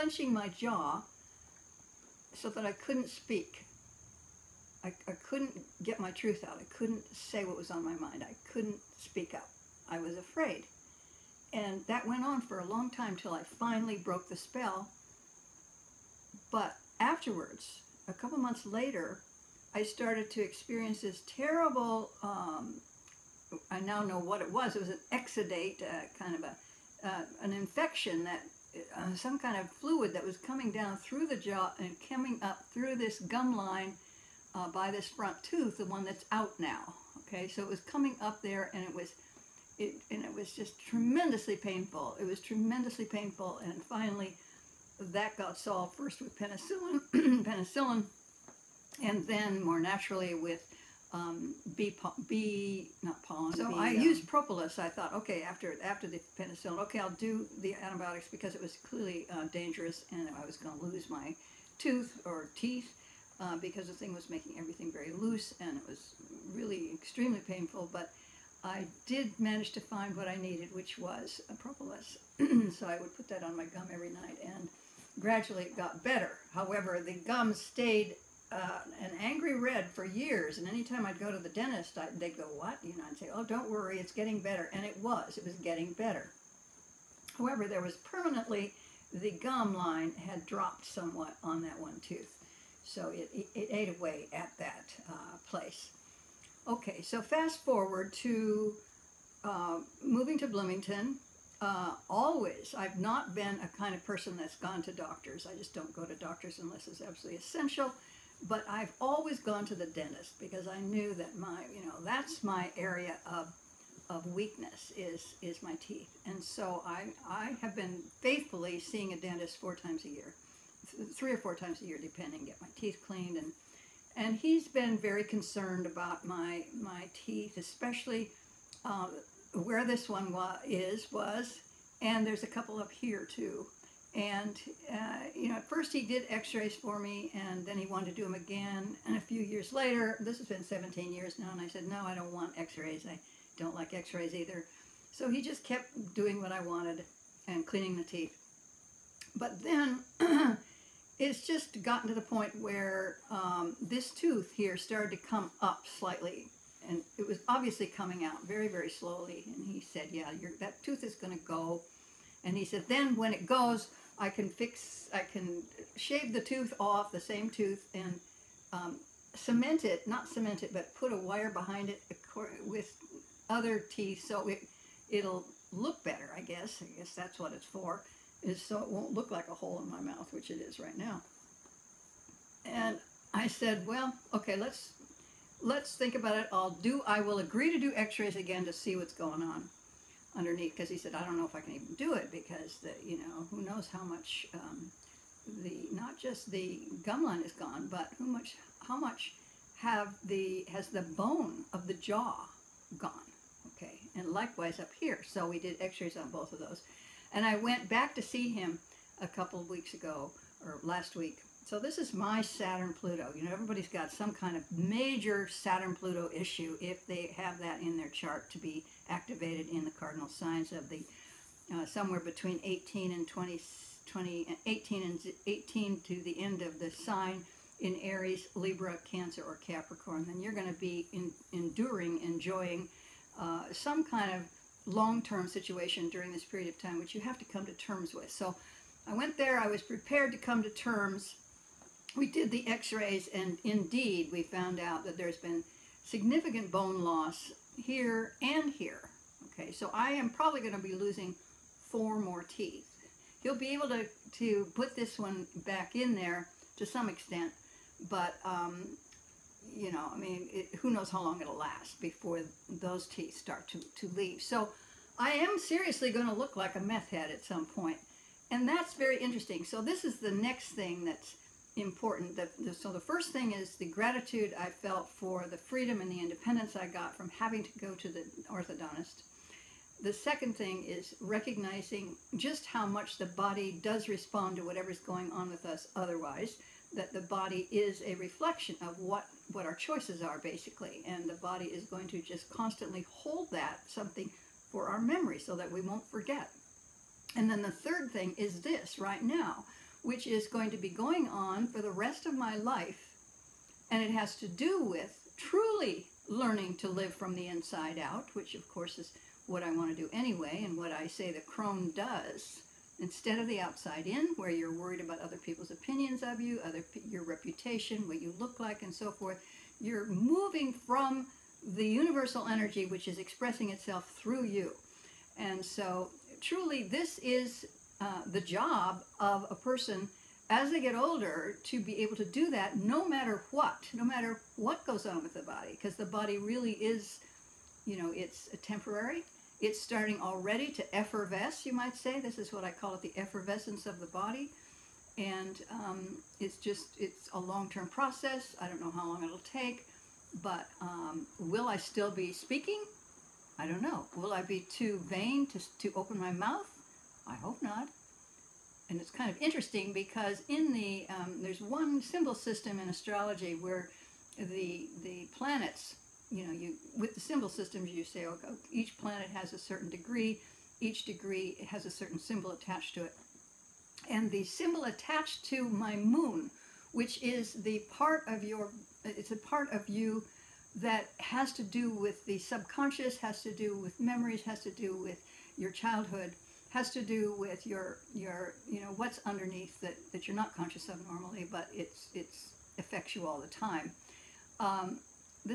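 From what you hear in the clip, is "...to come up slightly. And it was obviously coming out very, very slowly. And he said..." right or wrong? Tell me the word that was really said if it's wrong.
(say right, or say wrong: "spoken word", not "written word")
right.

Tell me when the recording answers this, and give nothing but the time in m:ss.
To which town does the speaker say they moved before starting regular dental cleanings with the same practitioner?
1:40.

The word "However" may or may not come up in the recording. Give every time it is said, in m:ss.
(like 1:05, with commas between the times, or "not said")
1:16, 1:27.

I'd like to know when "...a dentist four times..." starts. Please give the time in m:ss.
1:59.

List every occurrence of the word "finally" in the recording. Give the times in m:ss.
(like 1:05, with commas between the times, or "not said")
0:13, 0:43.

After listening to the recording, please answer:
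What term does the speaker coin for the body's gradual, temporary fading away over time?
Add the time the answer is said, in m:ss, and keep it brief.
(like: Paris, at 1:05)
effervescence, at 5:43.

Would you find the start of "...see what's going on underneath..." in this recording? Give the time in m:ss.
3:08.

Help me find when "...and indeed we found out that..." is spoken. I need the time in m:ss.
4:03.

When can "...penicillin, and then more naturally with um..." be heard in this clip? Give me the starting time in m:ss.
0:47.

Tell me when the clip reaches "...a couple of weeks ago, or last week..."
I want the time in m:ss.
3:29.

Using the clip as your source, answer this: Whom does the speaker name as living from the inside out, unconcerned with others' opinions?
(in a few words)
the crone.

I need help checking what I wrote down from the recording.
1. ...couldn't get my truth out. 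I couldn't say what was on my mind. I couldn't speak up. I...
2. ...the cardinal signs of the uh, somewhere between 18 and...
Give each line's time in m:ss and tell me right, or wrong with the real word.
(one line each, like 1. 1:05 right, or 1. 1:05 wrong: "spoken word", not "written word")
1. 0:05 right
2. 3:39 right.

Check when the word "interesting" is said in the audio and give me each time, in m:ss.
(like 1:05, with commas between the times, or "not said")
4:29, 5:59.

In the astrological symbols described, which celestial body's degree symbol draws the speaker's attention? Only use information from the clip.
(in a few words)
moon.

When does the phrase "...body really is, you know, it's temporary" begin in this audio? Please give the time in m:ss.
5:36.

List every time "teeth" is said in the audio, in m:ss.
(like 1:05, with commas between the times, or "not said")
1:02, 1:55, 2:02, 2:07, 2:28, 2:53, 4:12, 4:23.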